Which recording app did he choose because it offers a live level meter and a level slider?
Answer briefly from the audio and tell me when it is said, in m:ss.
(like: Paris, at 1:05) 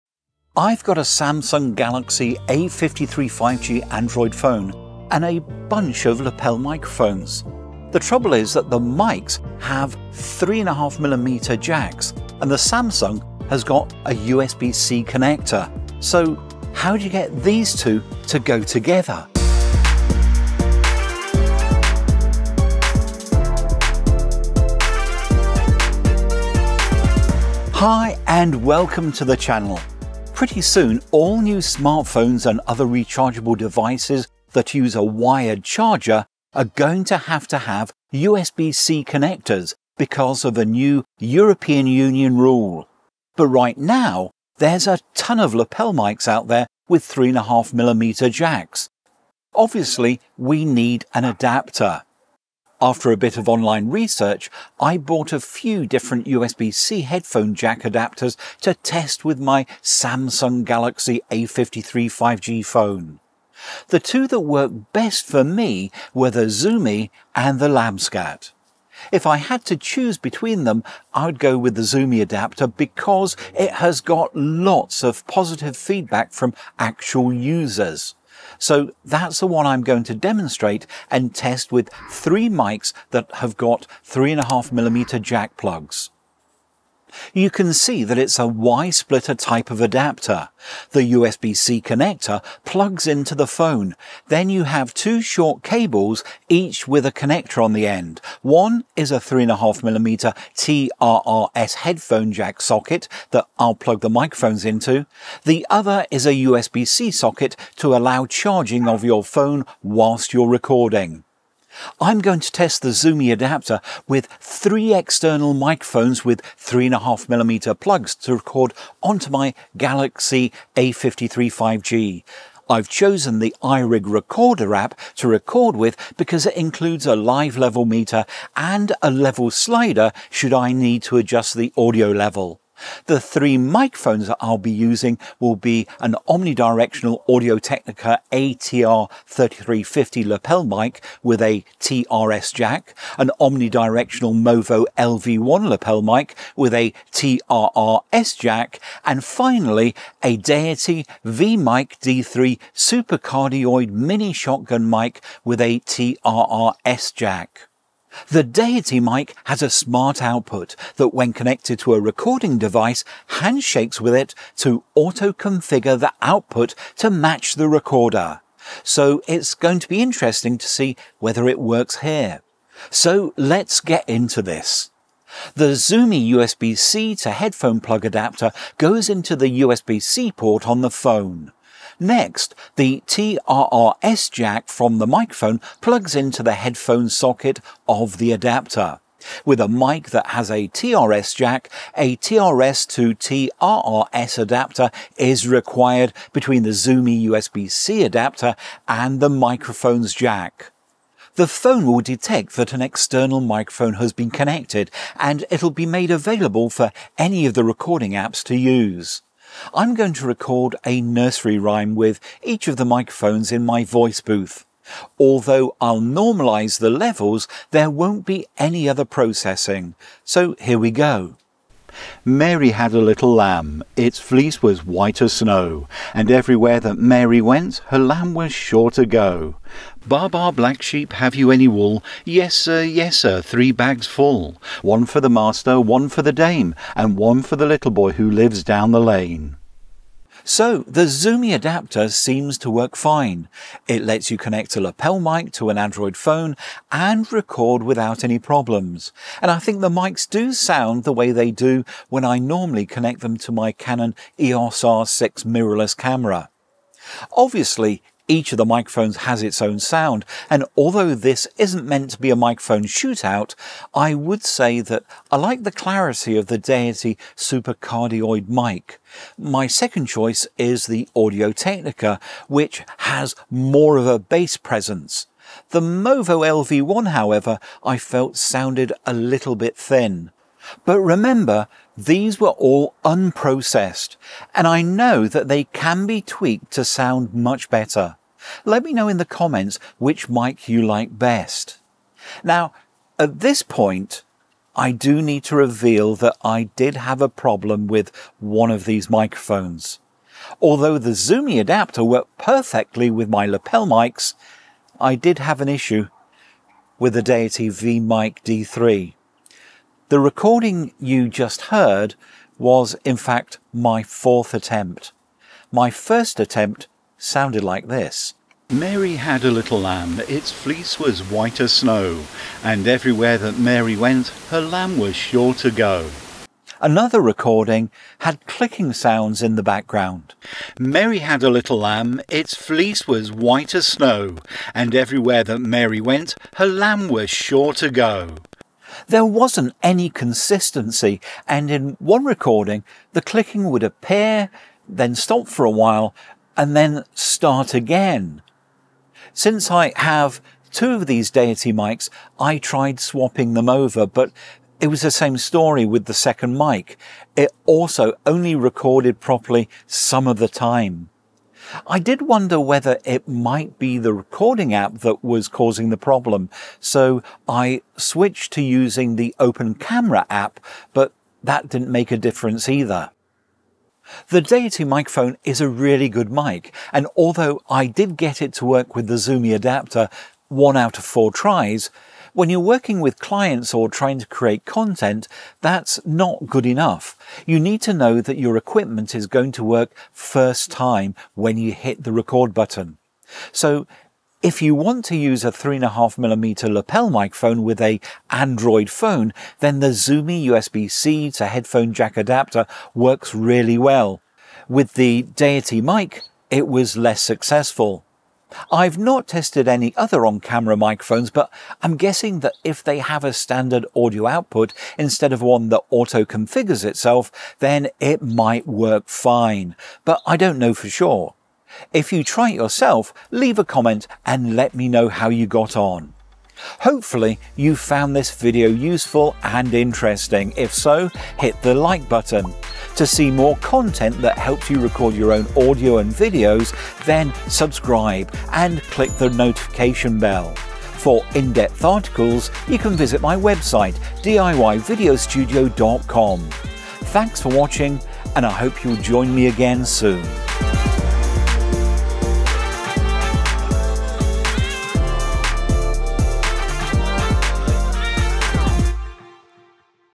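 iRig Recorder, at 2:03.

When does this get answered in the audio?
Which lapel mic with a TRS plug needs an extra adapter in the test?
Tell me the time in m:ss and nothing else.
2:17.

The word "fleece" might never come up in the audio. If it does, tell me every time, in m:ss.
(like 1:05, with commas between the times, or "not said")
3:44, 5:20, 5:32.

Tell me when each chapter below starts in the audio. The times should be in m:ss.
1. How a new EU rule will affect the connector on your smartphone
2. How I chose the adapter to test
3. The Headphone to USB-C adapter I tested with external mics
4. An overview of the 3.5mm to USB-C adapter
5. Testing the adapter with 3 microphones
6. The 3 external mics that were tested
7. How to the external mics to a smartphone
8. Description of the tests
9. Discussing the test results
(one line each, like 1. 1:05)
1. 0:27
2. 0:43
3. 1:03
4. 1:26
5. 1:51
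6. 2:12
7. 2:52
8. 3:21
9. 4:00.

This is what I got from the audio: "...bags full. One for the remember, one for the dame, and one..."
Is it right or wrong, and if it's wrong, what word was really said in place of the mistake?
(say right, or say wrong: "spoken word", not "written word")
wrong: "master", not "remember".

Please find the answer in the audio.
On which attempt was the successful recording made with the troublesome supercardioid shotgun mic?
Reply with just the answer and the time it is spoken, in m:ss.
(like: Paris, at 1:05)
4th, at 5:14.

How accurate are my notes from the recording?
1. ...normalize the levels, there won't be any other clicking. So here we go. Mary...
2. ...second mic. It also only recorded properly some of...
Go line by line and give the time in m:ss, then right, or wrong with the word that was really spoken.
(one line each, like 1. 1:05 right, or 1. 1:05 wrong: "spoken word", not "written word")
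1. 3:36 wrong: "processing", not "clicking"
2. 5:56 right.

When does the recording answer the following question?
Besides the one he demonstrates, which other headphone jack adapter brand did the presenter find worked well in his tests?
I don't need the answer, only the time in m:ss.
1:07.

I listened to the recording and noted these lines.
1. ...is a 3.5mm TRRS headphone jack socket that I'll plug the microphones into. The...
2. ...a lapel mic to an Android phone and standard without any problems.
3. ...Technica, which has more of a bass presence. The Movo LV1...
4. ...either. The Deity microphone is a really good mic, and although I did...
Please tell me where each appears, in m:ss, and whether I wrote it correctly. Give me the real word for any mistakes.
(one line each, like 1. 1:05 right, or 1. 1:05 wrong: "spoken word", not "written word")
1. 1:38 right
2. 4:04 wrong: "record", not "standard"
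3. 4:31 right
4. 6:12 right.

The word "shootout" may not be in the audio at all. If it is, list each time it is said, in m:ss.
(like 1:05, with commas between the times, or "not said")
4:22.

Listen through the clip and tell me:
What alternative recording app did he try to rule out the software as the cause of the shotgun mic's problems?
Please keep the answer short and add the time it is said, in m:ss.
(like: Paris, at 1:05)
Open Camera, at 6:09.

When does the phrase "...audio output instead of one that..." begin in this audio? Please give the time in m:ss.
6:53.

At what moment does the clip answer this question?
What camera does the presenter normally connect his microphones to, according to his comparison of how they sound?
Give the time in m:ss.
4:13.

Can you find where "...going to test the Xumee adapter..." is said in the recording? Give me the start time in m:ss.
1:52.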